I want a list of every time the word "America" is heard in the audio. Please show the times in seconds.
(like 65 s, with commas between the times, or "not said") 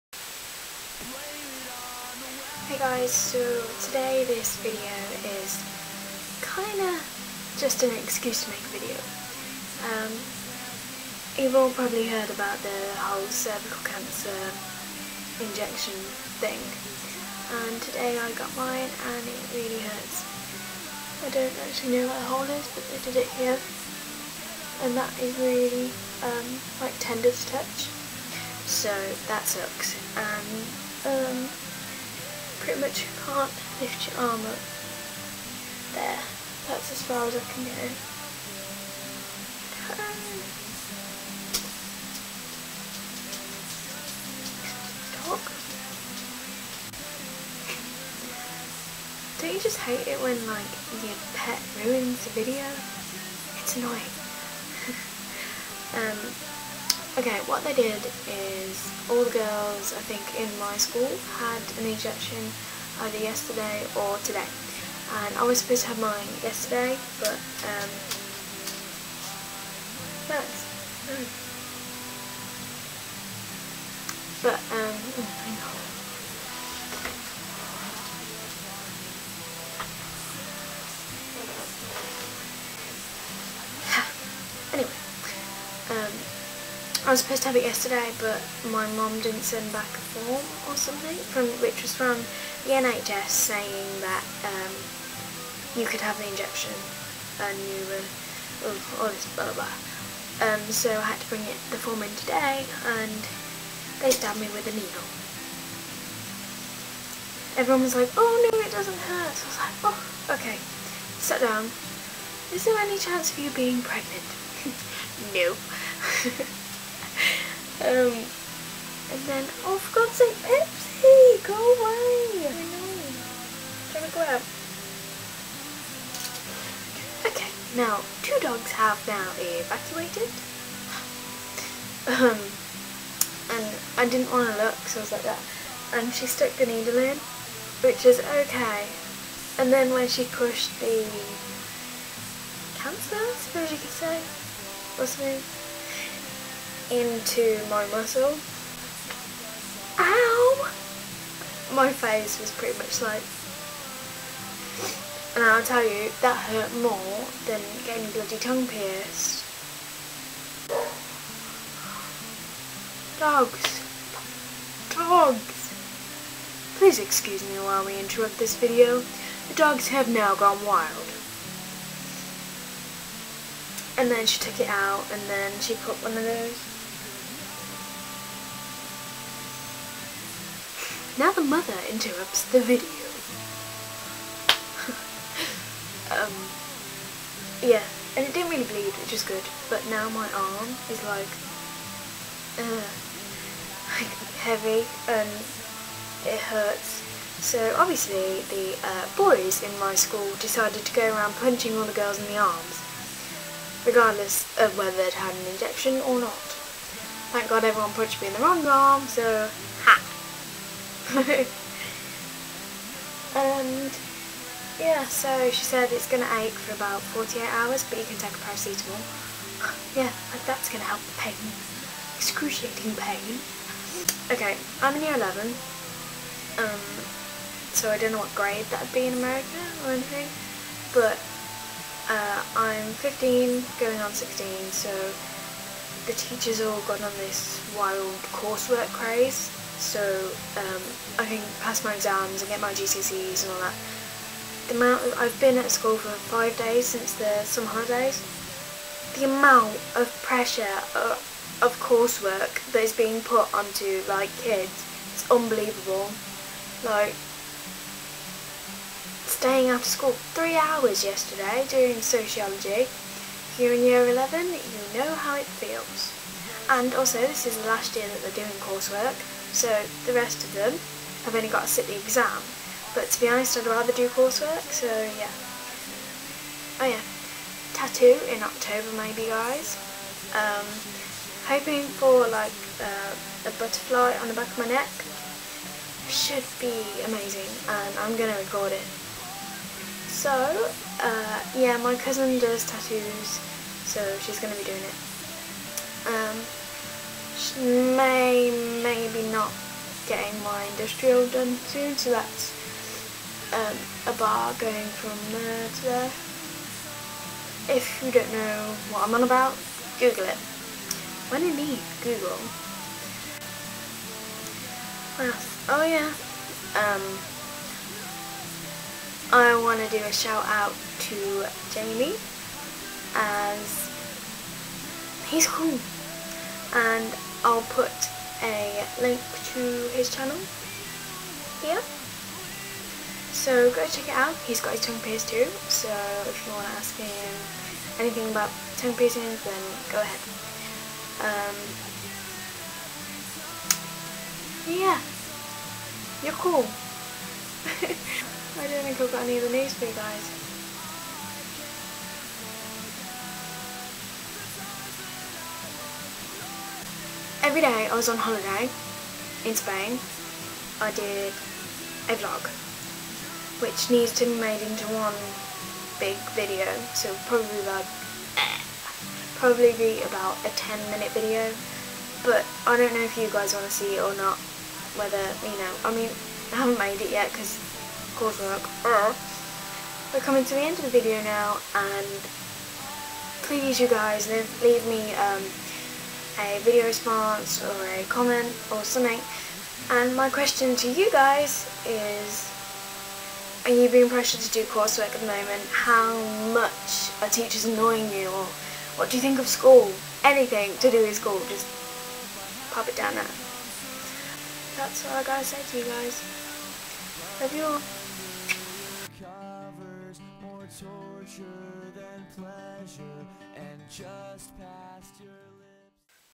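229 s.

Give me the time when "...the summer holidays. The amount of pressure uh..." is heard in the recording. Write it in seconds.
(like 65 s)
247 s.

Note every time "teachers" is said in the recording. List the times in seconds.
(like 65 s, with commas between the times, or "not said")
236 s, 397 s.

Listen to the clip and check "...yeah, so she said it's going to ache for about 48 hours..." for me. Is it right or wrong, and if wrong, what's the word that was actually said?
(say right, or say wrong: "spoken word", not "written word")
right.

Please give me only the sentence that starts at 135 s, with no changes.
And she stuck the needle in, which is okay.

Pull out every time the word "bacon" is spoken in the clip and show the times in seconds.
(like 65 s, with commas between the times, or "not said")
not said.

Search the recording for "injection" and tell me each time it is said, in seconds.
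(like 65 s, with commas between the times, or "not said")
15 s, 61 s, 96 s, 205 s.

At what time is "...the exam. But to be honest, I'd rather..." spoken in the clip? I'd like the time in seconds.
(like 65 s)
271 s.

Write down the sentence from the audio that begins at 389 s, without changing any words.
And my question to you guys is, are you being pressured to do coursework at the moment?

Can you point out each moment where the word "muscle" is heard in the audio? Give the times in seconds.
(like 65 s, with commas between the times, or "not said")
147 s.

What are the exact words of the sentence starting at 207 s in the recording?
Thank God everyone punched me in the wrong arm, so ha!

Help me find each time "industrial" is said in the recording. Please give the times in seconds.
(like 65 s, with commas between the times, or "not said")
300 s.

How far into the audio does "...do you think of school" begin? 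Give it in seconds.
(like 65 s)
399 s.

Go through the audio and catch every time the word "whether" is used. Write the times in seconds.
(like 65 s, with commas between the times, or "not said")
204 s, 374 s.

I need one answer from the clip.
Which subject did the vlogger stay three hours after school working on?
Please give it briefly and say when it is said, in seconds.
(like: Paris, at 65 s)
Sociology, at 262 s.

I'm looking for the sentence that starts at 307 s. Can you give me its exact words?
If you don't know what I'm on about, Google it.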